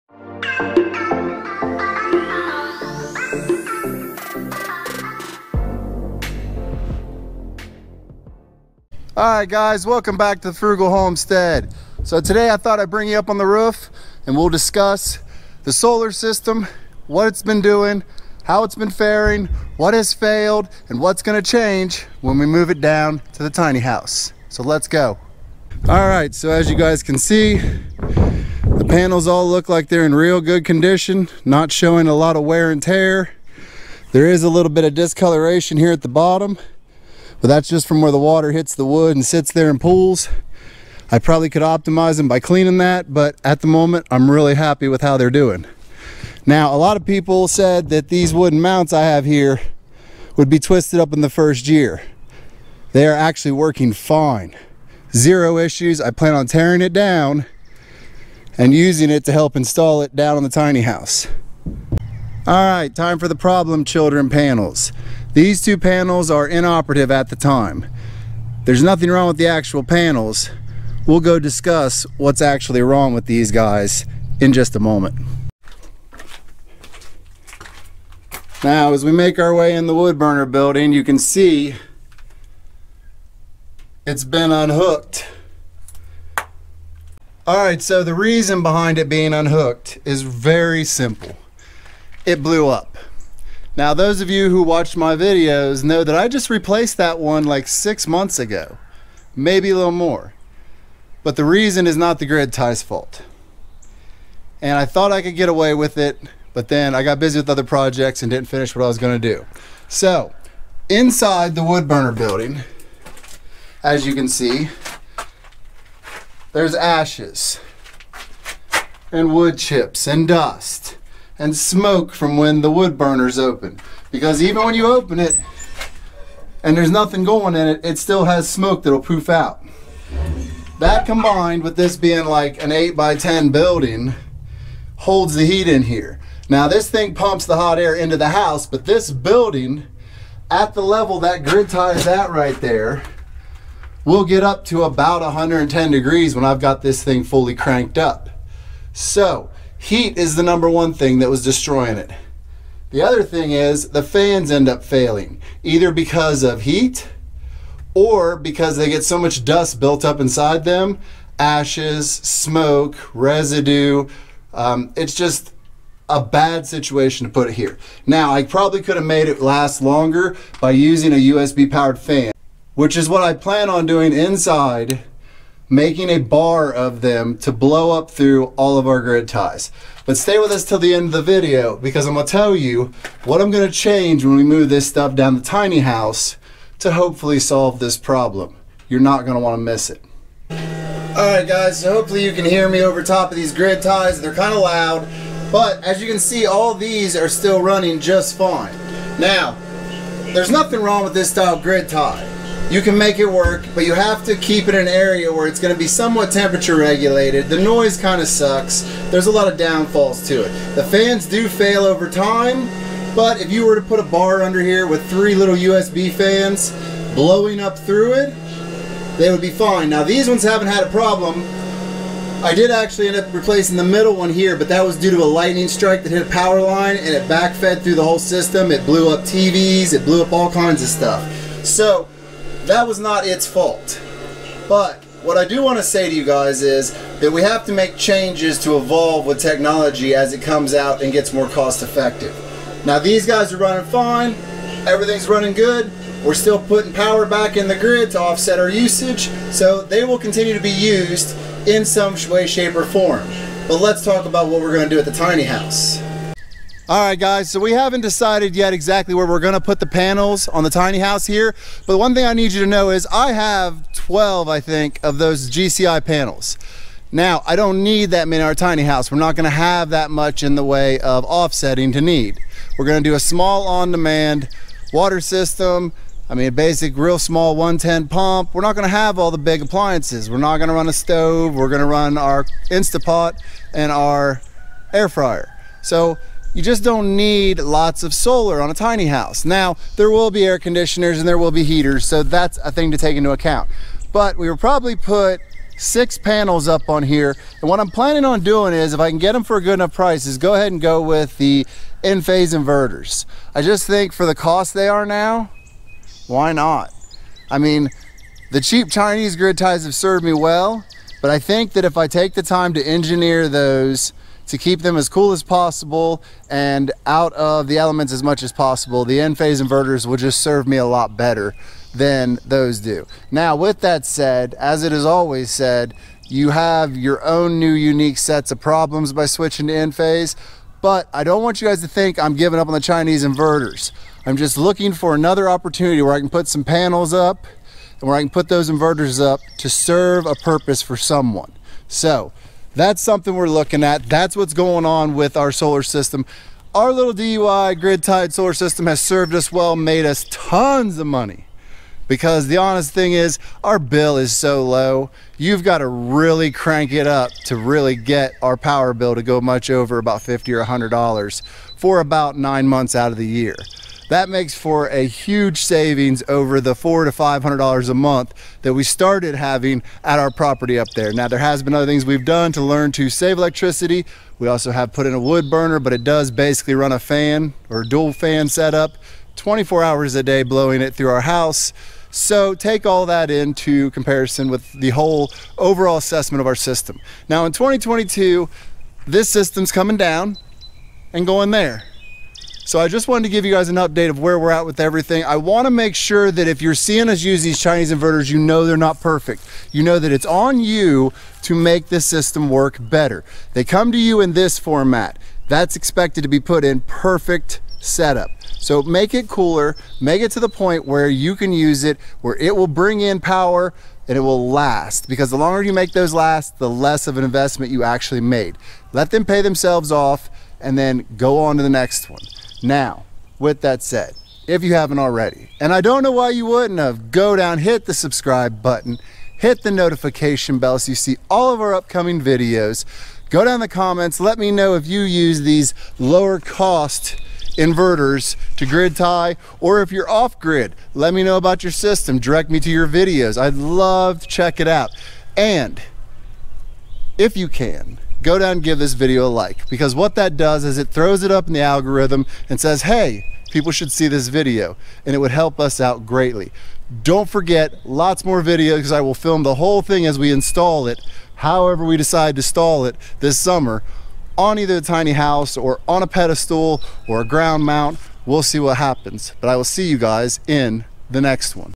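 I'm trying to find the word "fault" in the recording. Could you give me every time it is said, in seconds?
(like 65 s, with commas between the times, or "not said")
102 s, 233 s.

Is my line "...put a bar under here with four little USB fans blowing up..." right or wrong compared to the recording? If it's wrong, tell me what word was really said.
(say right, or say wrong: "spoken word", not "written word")
wrong: "three", not "four".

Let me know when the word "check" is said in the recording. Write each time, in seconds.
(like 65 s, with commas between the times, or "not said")
444 s.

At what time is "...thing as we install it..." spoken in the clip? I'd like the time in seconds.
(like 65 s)
459 s.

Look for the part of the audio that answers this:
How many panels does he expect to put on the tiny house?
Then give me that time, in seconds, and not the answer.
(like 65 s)
295 s.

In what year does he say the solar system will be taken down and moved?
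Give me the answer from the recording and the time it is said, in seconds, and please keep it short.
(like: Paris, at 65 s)
2022, at 387 s.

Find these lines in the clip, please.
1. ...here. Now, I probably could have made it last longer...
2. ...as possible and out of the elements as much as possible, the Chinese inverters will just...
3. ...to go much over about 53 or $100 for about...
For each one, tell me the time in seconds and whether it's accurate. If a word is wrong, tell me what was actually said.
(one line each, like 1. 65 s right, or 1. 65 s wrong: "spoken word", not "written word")
1. 167 s right
2. 315 s wrong: "Enphase", not "Chinese"
3. 359 s wrong: "50", not "53".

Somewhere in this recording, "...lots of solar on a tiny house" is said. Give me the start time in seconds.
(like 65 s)
287 s.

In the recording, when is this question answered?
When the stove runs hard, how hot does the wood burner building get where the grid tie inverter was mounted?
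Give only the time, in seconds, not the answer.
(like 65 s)
145 s.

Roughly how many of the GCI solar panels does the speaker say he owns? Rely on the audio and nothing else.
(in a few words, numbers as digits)
12.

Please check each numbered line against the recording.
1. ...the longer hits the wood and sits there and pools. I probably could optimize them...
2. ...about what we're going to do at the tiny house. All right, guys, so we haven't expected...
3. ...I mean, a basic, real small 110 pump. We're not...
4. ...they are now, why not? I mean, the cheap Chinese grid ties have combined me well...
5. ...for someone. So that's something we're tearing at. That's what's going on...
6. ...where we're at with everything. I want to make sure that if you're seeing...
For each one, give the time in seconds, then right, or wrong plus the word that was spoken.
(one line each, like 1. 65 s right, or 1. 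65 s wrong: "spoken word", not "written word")
1. 38 s wrong: "water", not "longer"
2. 254 s wrong: "decided", not "expected"
3. 276 s right
4. 304 s wrong: "served", not "combined"
5. 340 s wrong: "looking", not "tearing"
6. 394 s right.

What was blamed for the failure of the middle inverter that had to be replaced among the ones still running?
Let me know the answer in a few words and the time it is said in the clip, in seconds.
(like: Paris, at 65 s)
A lightning strike, at 225 s.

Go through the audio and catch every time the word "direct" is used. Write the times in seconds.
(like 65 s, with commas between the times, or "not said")
442 s.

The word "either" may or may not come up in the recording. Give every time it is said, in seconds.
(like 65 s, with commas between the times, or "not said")
155 s, 464 s.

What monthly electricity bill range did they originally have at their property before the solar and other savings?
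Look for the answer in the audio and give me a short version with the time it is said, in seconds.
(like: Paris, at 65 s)
$400 to $500, at 366 s.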